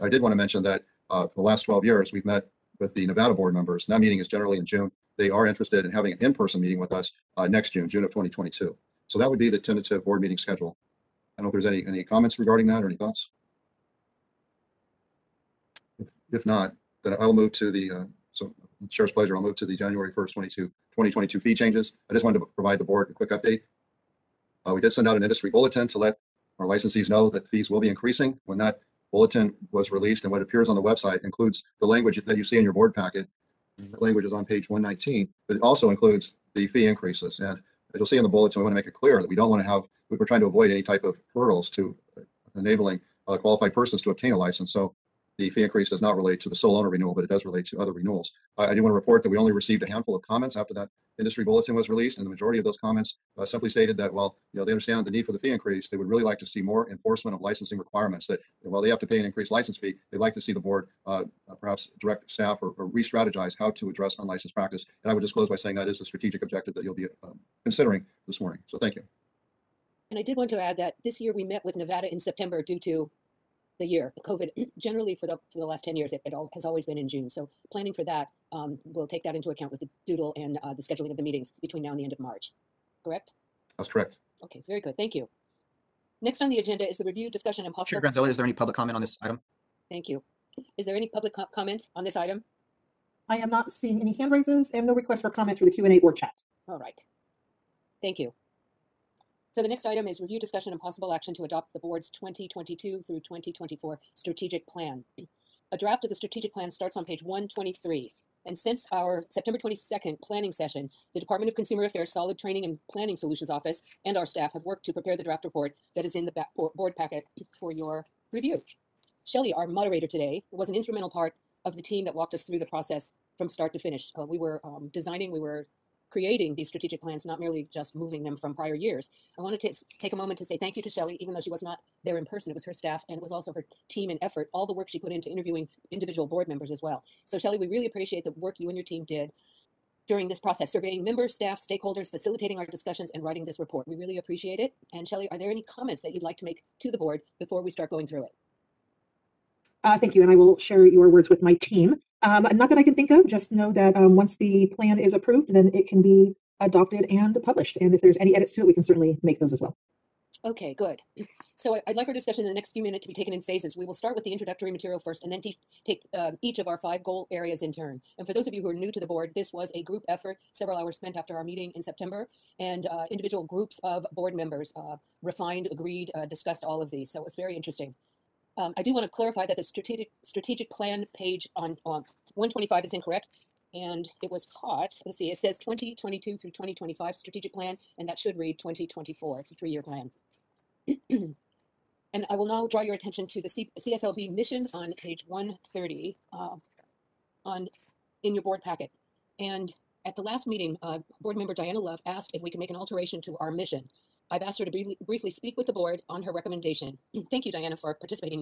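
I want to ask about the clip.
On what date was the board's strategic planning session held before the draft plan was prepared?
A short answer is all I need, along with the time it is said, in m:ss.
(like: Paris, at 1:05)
September 22, at 1:49.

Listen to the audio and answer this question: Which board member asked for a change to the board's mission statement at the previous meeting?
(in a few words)
Diana Love.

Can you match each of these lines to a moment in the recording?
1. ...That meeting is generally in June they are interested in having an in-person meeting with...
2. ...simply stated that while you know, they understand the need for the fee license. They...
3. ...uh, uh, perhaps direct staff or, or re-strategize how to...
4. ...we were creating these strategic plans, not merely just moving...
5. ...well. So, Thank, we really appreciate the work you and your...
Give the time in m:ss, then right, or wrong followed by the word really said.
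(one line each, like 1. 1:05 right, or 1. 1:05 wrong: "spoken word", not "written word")
1. 0:03 right
2. 0:53 wrong: "increase", not "license"
3. 1:01 right
4. 2:05 right
5. 2:16 wrong: "Shelly", not "Thank".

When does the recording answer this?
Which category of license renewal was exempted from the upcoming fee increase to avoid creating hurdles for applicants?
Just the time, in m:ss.
0:46.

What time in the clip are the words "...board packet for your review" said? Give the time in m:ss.
1:56.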